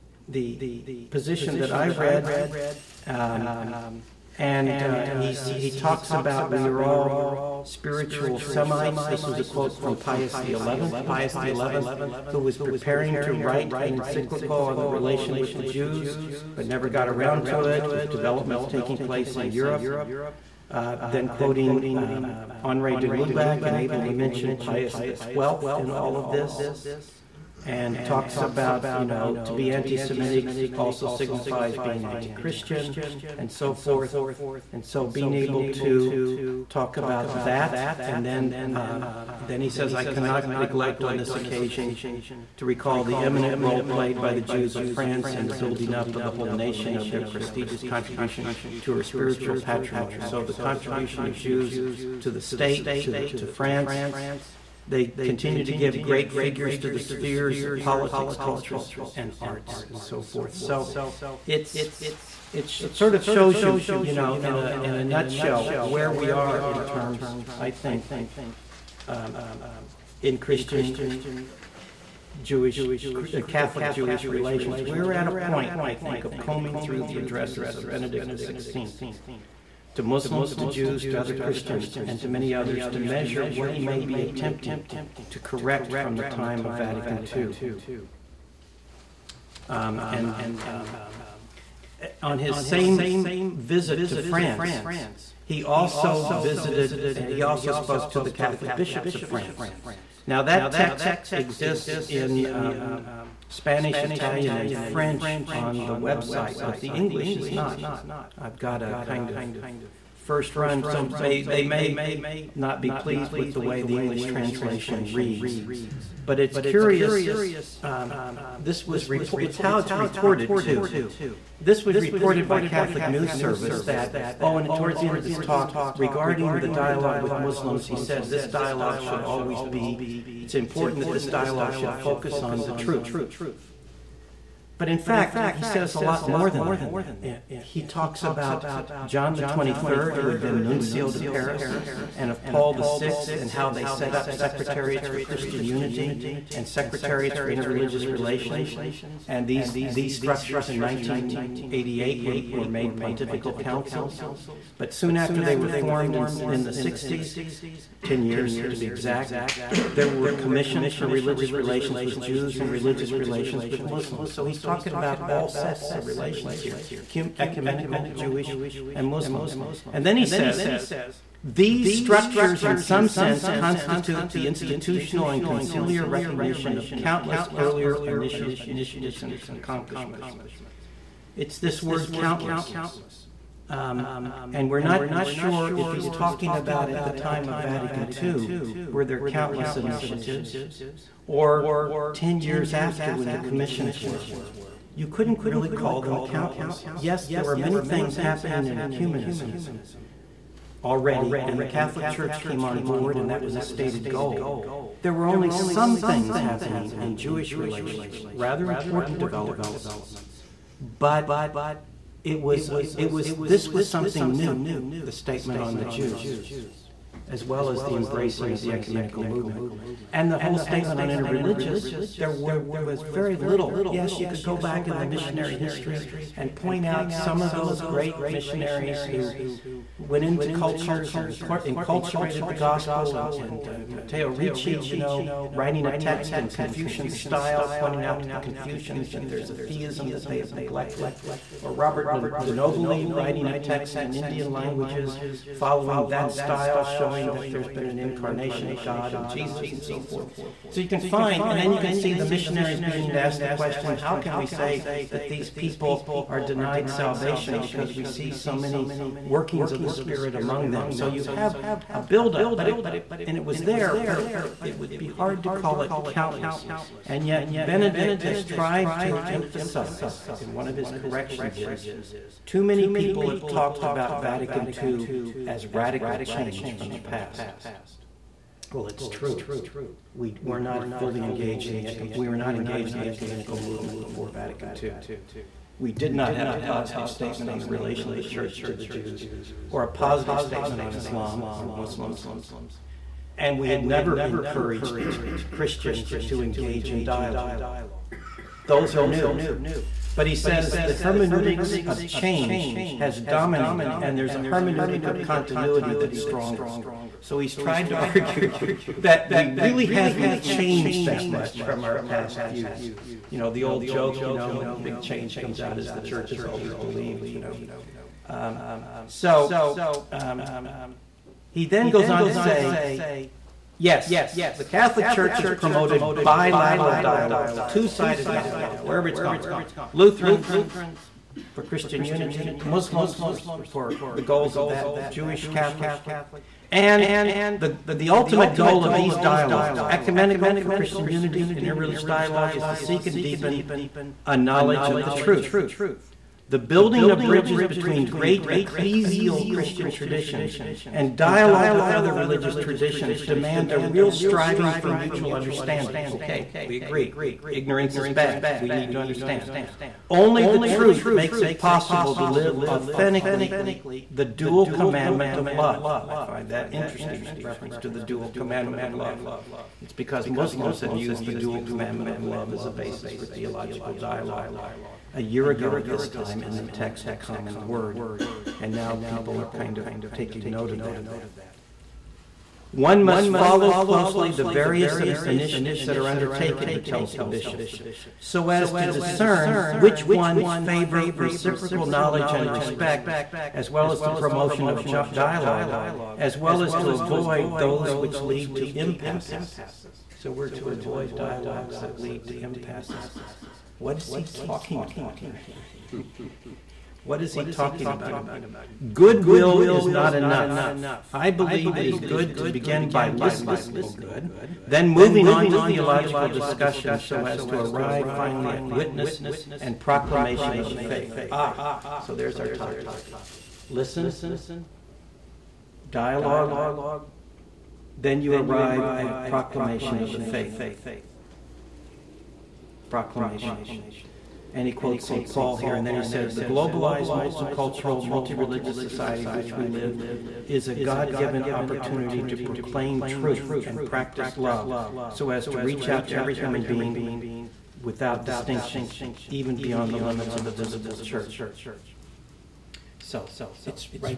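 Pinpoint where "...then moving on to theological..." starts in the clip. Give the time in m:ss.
6:54.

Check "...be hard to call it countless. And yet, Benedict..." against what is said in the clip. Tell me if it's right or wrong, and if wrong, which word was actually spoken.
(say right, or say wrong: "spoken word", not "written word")
right.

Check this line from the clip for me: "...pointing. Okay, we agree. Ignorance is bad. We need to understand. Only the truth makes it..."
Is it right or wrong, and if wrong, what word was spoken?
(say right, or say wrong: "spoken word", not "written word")
wrong: "understanding", not "pointing".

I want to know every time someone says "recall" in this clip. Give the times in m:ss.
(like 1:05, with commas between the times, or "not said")
0:42.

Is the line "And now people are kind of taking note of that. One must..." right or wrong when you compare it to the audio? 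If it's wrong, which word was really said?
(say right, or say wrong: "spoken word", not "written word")
right.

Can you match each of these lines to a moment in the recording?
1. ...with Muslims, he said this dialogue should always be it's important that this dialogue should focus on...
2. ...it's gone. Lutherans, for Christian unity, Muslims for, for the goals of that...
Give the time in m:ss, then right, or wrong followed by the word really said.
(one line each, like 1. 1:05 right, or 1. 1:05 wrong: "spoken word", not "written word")
1. 2:07 right
2. 5:29 right.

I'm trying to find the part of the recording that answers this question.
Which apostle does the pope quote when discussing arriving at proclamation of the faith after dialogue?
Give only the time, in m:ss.
7:15.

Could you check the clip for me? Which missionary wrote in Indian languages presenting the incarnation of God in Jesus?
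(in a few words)
Robert de Nobili.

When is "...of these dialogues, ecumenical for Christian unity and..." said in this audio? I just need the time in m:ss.
5:38.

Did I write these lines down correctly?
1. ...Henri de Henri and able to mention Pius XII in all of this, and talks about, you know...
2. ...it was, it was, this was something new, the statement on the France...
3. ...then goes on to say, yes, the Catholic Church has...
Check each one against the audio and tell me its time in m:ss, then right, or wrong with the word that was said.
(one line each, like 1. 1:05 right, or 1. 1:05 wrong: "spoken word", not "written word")
1. 0:22 wrong: "Lubac", not "Henri"
2. 3:32 wrong: "Jews", not "France"
3. 5:21 right.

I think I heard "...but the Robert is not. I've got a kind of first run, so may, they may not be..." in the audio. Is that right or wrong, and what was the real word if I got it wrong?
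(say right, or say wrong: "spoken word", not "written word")
wrong: "English", not "Robert".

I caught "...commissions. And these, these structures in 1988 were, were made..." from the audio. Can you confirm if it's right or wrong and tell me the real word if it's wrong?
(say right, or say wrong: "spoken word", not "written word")
wrong: "relations", not "commissions".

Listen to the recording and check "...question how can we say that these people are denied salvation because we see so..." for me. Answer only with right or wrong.
right.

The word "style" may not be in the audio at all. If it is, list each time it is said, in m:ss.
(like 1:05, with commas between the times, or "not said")
3:57, 4:06.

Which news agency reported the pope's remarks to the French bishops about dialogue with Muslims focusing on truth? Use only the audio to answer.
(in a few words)
Catholic News Service.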